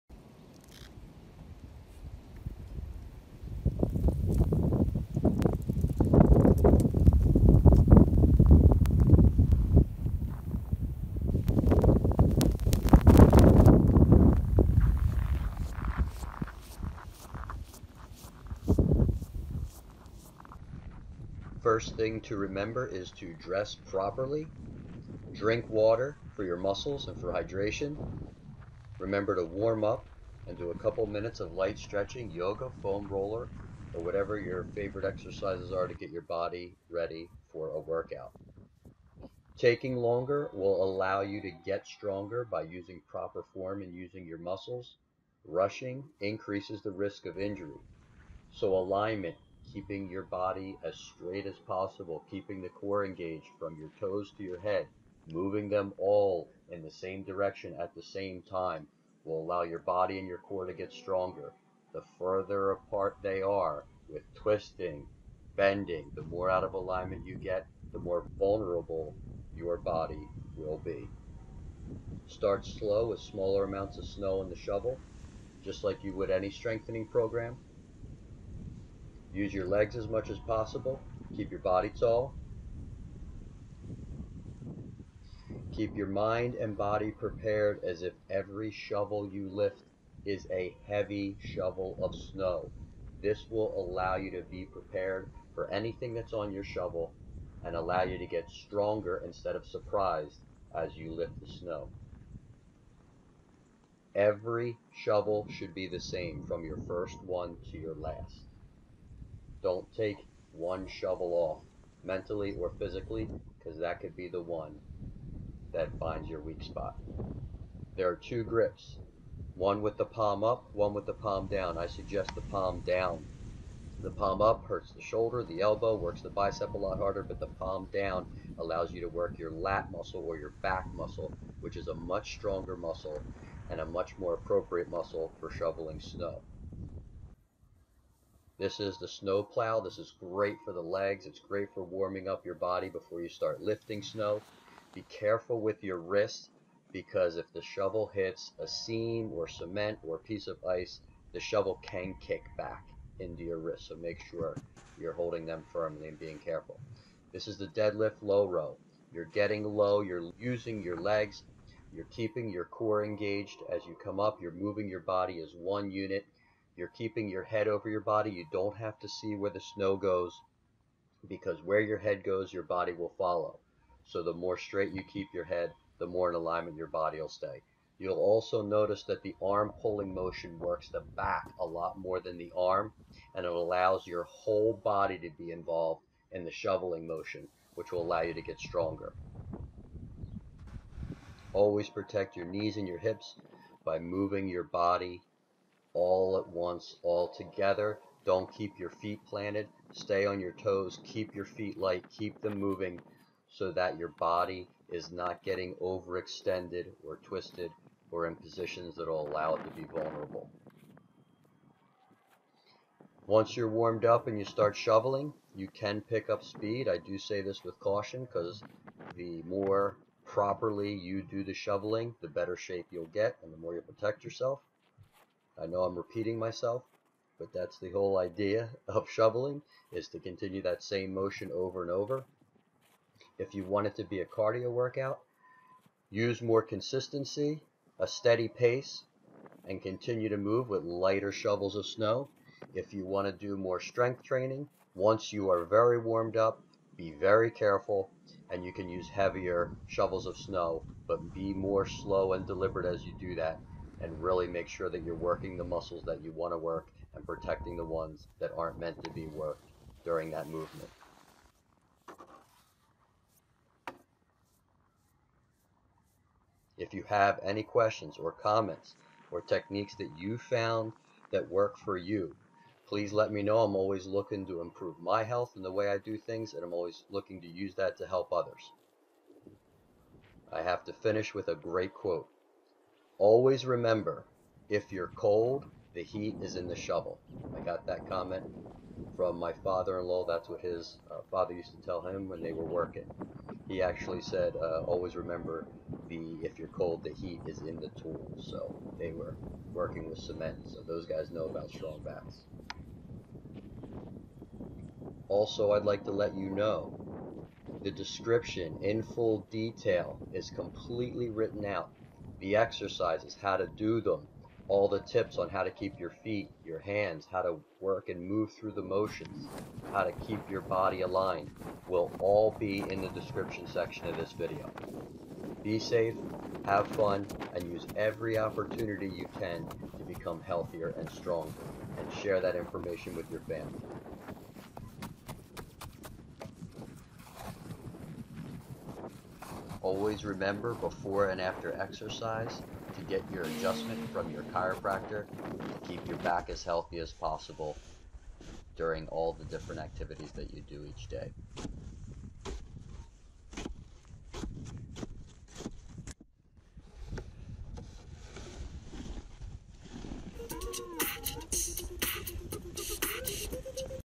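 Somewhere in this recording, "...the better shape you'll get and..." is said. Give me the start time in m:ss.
3:42.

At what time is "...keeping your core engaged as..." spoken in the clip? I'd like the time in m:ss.
2:42.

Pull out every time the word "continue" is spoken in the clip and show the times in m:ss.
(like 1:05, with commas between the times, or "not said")
3:50, 3:59.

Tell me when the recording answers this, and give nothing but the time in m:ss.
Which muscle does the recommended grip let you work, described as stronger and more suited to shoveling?
2:09.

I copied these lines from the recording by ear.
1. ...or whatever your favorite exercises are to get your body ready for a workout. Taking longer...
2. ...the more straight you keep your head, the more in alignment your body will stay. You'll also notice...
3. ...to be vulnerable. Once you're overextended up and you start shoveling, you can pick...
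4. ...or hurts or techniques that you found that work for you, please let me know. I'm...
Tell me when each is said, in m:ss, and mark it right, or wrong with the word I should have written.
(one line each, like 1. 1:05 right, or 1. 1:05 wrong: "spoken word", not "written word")
1. 0:33 right
2. 2:54 right
3. 3:29 wrong: "warmed", not "overextended"
4. 4:28 wrong: "comments", not "hurts".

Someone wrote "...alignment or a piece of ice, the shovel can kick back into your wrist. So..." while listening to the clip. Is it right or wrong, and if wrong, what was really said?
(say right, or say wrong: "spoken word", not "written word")
wrong: "cement", not "alignment".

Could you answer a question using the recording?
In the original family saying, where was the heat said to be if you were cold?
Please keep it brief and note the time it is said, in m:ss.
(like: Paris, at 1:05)
In the tool, at 4:57.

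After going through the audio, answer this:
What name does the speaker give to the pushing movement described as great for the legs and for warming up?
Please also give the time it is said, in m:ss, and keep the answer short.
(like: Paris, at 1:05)
Snow plow, at 2:19.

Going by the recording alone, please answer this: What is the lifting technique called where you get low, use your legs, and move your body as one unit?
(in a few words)
Deadlift low row.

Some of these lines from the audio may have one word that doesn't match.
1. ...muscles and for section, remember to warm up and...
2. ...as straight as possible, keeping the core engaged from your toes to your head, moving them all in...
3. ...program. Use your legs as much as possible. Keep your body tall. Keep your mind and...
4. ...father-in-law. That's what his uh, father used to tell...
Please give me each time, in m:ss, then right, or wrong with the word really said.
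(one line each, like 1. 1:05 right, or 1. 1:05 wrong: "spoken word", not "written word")
1. 0:26 wrong: "hydration", not "section"
2. 0:50 right
3. 1:17 right
4. 4:49 right.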